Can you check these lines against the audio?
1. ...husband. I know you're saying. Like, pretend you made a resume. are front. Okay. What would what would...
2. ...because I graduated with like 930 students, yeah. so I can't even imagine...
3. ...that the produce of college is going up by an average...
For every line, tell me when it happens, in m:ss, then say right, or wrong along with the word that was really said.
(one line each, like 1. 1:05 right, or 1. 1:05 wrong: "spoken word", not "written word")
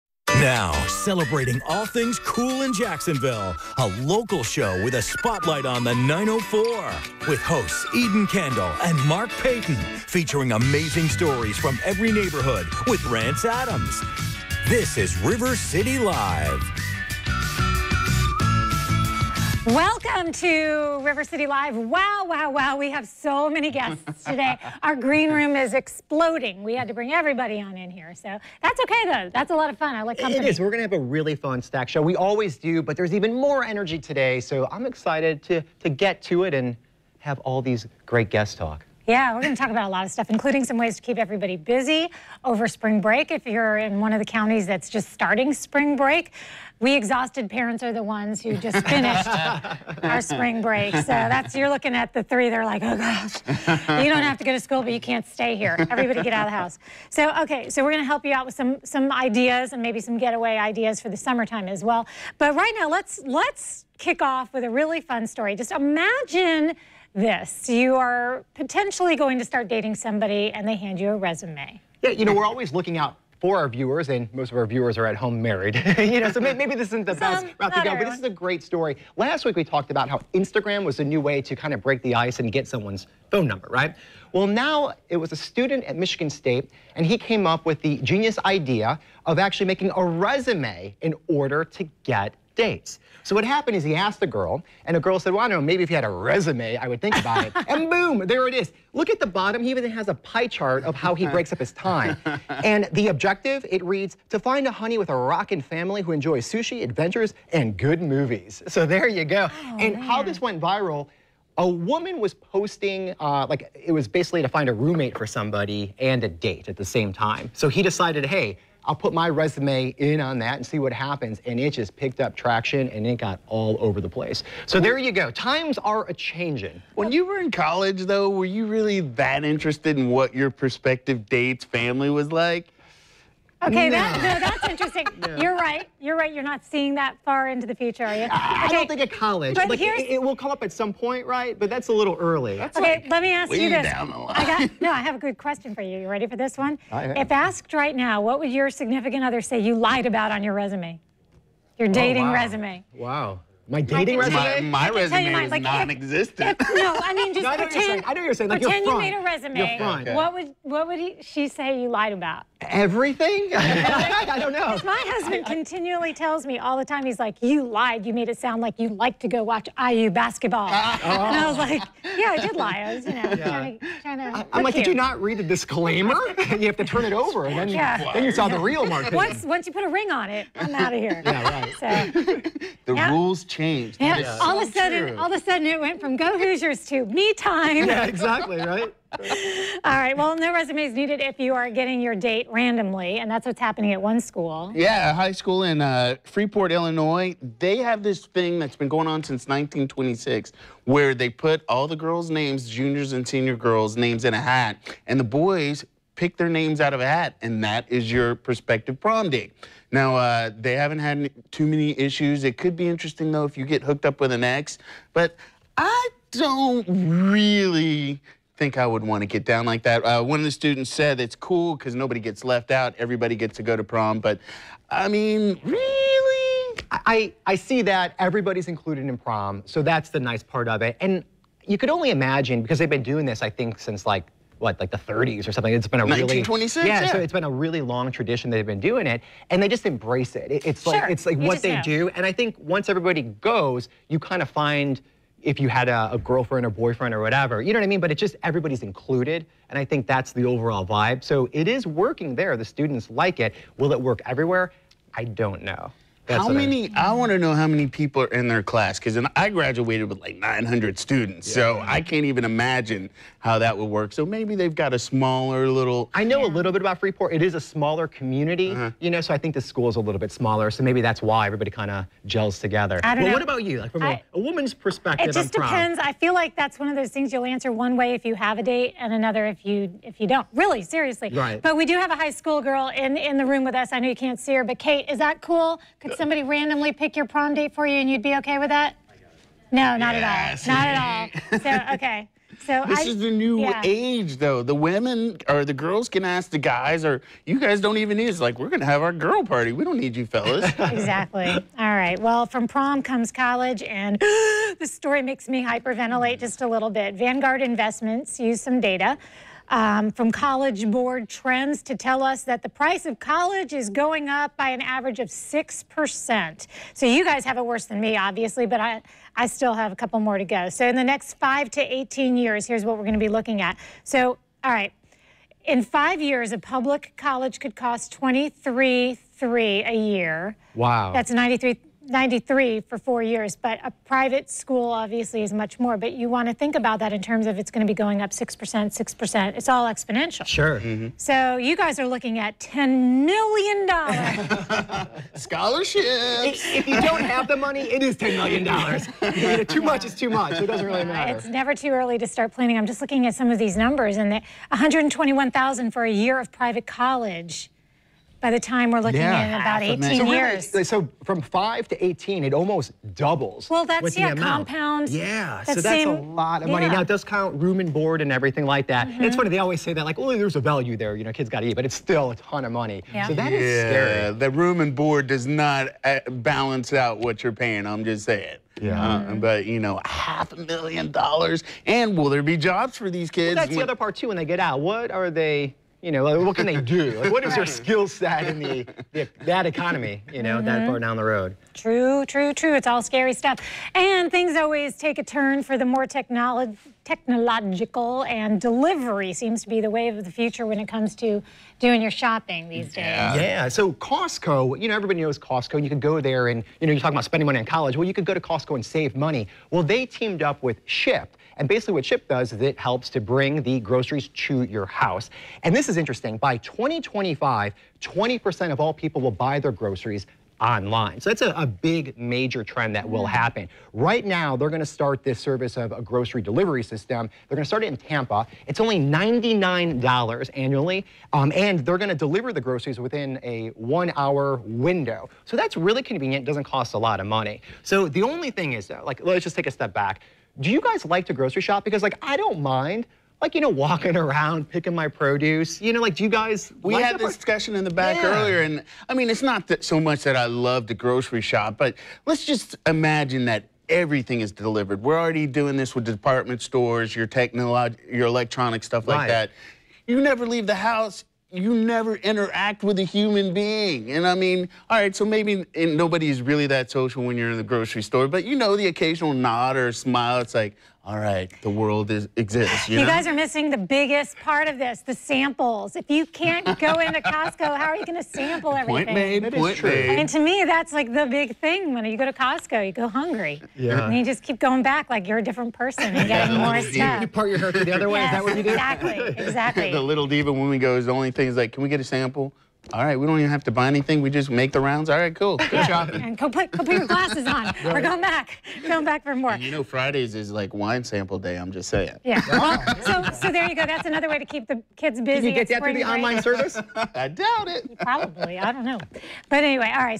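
1. 2:37 wrong: "pretend", not "husband"
2. 4:18 wrong: "900", not "930"
3. 5:12 wrong: "price", not "produce".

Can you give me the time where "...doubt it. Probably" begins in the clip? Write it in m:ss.
8:27.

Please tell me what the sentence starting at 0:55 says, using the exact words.
Everybody get out of the house.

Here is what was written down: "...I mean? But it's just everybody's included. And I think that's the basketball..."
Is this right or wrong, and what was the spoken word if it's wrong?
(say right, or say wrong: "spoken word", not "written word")
wrong: "overall", not "basketball".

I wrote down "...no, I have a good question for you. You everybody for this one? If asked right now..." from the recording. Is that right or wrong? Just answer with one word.
wrong.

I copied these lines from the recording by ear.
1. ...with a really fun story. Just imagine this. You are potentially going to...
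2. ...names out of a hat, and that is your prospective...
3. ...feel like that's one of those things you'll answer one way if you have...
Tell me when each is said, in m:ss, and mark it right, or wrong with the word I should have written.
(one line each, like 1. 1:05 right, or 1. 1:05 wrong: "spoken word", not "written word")
1. 1:04 right
2. 3:26 right
3. 4:36 right.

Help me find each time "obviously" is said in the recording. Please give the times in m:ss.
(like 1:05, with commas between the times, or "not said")
5:18, 5:34.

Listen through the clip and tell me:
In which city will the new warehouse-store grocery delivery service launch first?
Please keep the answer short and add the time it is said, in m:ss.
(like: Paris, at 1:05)
Tampa, at 7:07.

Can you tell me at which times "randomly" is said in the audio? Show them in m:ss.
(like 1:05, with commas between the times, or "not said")
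3:12, 4:46.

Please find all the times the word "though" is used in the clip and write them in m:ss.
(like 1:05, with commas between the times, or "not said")
0:29, 2:08, 3:33, 4:54, 7:18.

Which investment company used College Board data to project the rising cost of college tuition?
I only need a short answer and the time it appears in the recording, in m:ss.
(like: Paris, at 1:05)
Vanguard Investments, at 5:07.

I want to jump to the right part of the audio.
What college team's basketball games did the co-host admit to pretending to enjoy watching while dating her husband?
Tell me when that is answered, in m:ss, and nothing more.
2:49.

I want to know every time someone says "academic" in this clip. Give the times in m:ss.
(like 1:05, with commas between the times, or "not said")
not said.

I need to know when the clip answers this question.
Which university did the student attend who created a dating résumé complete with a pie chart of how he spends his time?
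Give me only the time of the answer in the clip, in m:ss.
1:25.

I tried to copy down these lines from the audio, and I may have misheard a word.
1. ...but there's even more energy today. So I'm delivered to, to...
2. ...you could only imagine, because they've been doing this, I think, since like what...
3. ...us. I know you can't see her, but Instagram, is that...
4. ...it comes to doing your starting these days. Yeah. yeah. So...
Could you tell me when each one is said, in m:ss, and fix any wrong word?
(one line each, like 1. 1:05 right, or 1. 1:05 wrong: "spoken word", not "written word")
1. 0:32 wrong: "excited", not "delivered"
2. 3:51 right
3. 4:43 wrong: "Kate", not "Instagram"
4. 6:40 wrong: "shopping", not "starting".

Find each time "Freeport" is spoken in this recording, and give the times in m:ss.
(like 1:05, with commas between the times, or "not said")
3:16, 4:26.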